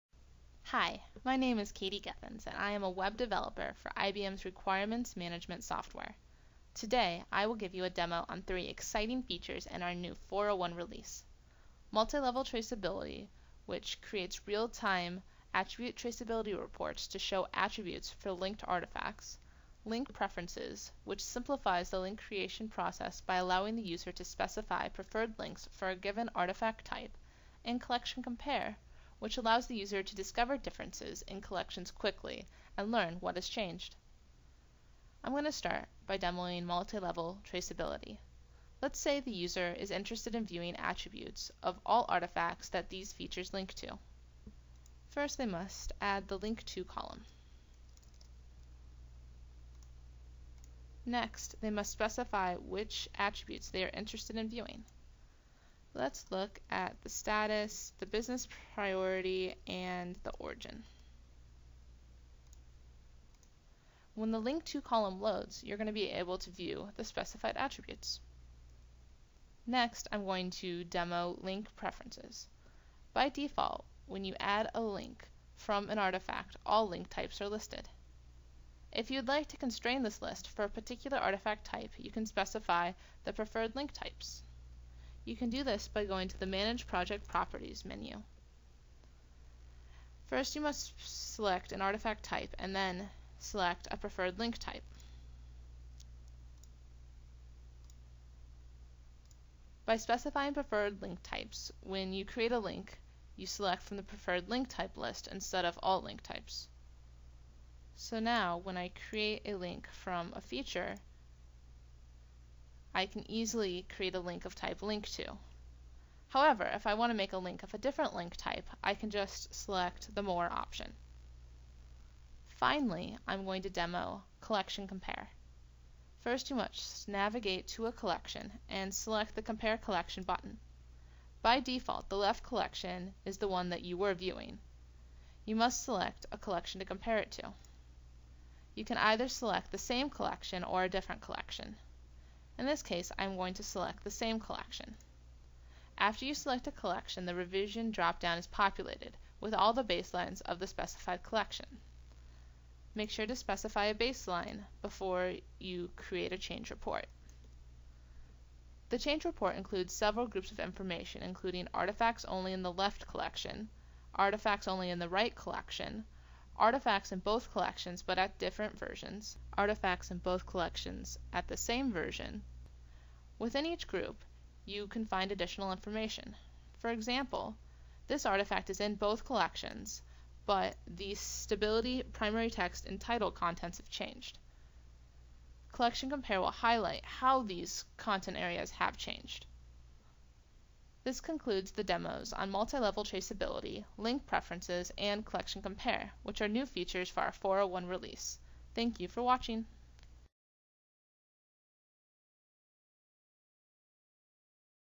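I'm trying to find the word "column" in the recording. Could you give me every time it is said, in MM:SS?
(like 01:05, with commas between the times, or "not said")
00:46, 01:04.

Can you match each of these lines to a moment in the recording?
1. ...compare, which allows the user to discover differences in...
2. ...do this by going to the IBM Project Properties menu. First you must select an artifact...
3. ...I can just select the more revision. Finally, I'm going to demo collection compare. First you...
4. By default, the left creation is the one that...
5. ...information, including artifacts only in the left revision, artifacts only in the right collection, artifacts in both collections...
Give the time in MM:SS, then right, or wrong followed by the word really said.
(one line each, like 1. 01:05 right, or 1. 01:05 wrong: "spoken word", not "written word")
1. 00:28 right
2. 01:25 wrong: "Manage", not "IBM"
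3. 01:58 wrong: "option", not "revision"
4. 02:11 wrong: "collection", not "creation"
5. 02:40 wrong: "collection", not "revision".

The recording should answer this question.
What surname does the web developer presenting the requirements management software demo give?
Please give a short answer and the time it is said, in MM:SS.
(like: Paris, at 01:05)
Geffens, at 00:01.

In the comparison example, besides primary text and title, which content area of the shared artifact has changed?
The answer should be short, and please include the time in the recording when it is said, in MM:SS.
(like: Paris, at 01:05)
Stability, at 03:01.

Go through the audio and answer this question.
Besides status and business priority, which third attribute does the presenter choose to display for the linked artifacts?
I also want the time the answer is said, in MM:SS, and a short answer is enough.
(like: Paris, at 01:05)
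Origin, at 01:00.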